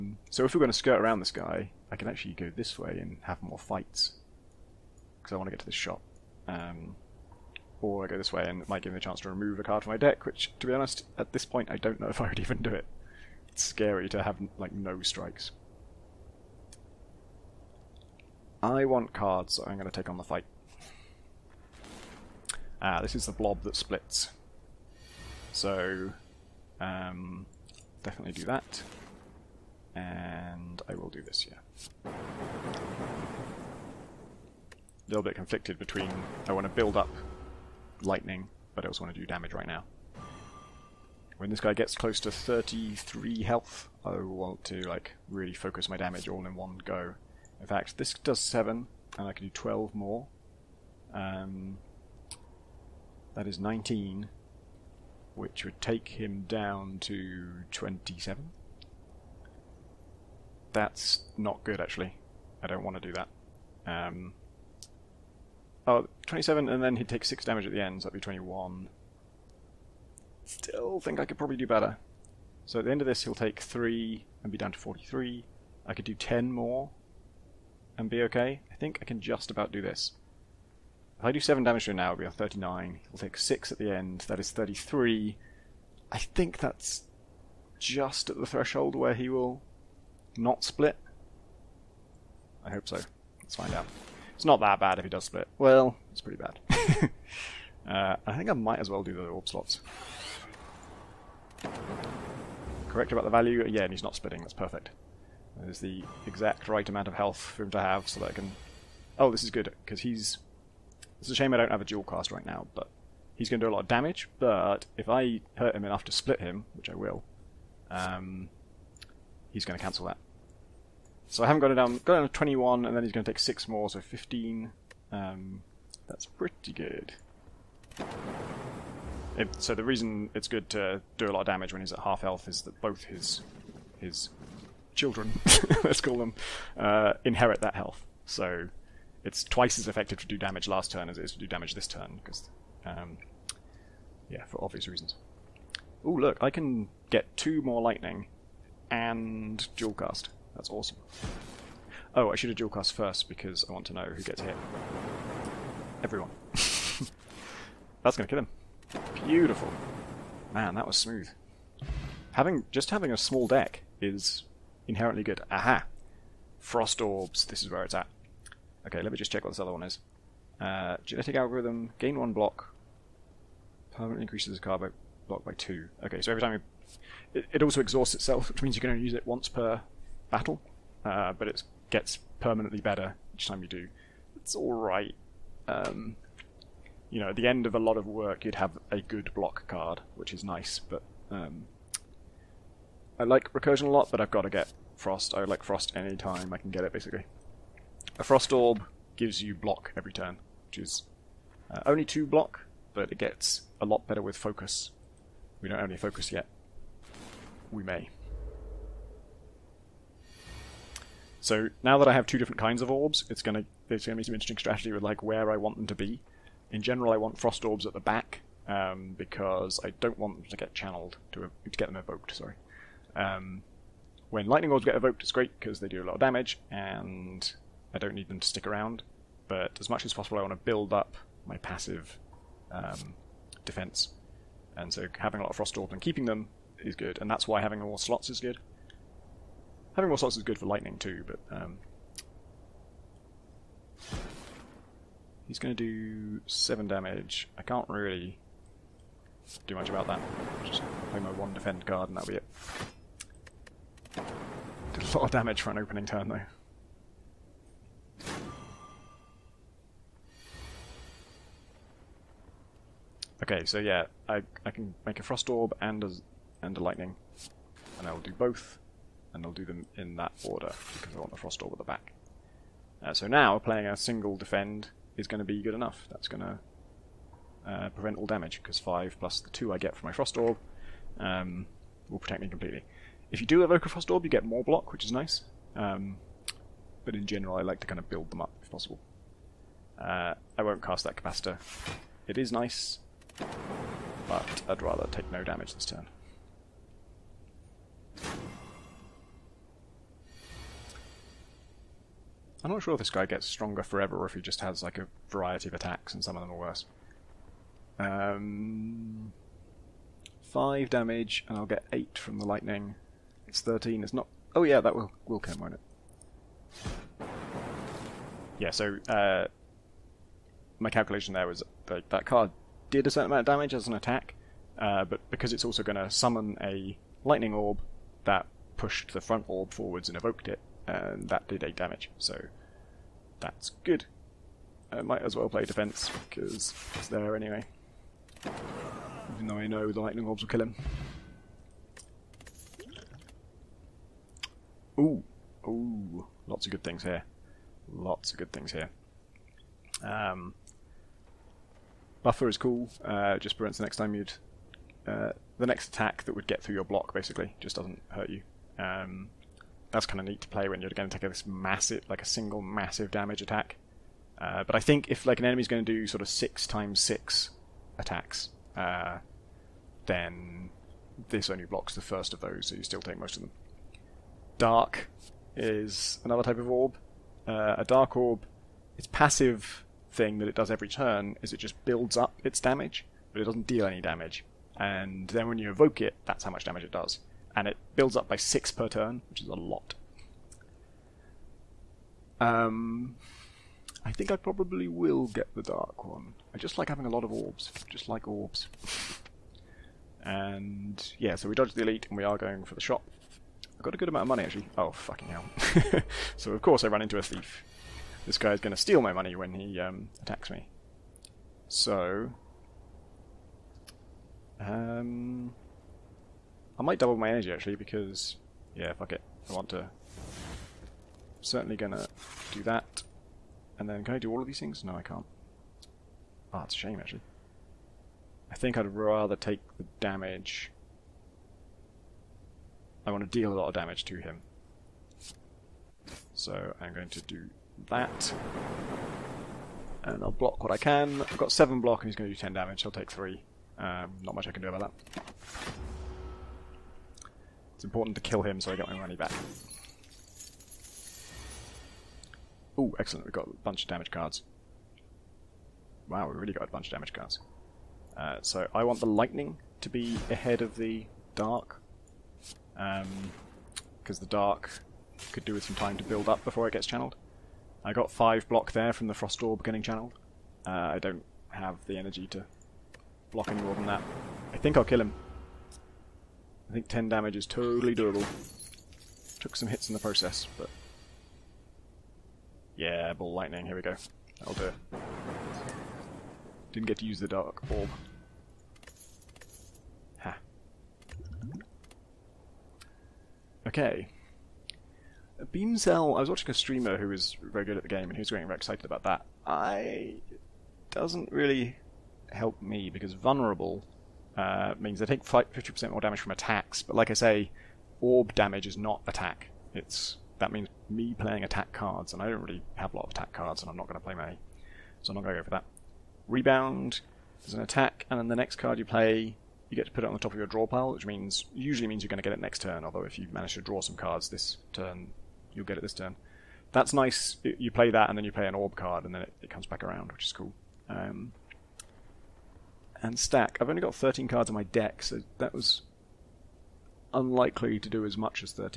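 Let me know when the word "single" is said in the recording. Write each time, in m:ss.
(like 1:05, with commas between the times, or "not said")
4:33, 6:02.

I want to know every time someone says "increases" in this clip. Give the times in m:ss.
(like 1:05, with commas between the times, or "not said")
2:54.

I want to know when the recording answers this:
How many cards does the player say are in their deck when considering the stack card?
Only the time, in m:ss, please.
8:53.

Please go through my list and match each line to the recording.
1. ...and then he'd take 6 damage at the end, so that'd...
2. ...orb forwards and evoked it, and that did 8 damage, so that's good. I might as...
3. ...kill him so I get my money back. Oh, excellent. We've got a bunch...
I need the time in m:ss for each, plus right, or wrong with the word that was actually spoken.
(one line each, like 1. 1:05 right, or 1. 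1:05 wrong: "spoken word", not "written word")
1. 1:06 right
2. 5:29 right
3. 7:28 right.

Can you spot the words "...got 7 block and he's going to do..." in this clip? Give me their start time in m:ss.
7:21.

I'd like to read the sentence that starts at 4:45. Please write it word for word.
Um, but in general I like to kind of build them up if possible.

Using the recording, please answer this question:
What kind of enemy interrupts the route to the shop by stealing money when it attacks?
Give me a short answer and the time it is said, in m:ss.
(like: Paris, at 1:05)
A thief, at 6:47.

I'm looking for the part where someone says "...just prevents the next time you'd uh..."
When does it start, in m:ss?
5:53.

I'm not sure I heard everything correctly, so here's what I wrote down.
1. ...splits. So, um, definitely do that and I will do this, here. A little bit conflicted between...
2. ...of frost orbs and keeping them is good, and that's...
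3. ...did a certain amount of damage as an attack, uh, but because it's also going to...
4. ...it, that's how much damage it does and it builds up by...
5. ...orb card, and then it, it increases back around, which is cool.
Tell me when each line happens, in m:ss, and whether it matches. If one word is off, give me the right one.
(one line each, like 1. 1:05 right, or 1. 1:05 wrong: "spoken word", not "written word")
1. 0:23 right
2. 3:55 right
3. 5:22 right
4. 6:26 right
5. 8:48 wrong: "comes", not "increases".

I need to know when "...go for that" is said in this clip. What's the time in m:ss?
8:35.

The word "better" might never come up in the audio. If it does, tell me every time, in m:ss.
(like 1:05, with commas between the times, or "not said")
1:11, 3:02, 3:24.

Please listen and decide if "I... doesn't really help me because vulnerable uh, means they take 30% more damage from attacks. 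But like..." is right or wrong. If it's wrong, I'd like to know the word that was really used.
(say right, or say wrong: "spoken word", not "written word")
wrong: "50", not "30".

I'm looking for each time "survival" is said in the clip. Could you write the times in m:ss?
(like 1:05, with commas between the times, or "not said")
not said.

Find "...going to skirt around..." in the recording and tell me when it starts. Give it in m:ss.
0:00.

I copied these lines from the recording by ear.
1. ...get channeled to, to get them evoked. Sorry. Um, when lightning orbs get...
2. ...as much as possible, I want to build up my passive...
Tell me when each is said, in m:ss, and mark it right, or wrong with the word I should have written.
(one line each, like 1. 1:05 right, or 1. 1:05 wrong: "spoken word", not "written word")
1. 3:40 right
2. 3:49 right.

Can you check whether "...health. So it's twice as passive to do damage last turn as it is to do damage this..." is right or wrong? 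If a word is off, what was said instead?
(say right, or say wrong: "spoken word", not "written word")
wrong: "effective", not "passive".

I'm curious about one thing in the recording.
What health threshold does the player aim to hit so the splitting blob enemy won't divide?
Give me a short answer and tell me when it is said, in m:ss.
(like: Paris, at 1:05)
33, at 0:42.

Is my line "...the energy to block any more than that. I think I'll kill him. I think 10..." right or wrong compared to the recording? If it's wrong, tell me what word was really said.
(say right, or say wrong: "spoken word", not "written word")
right.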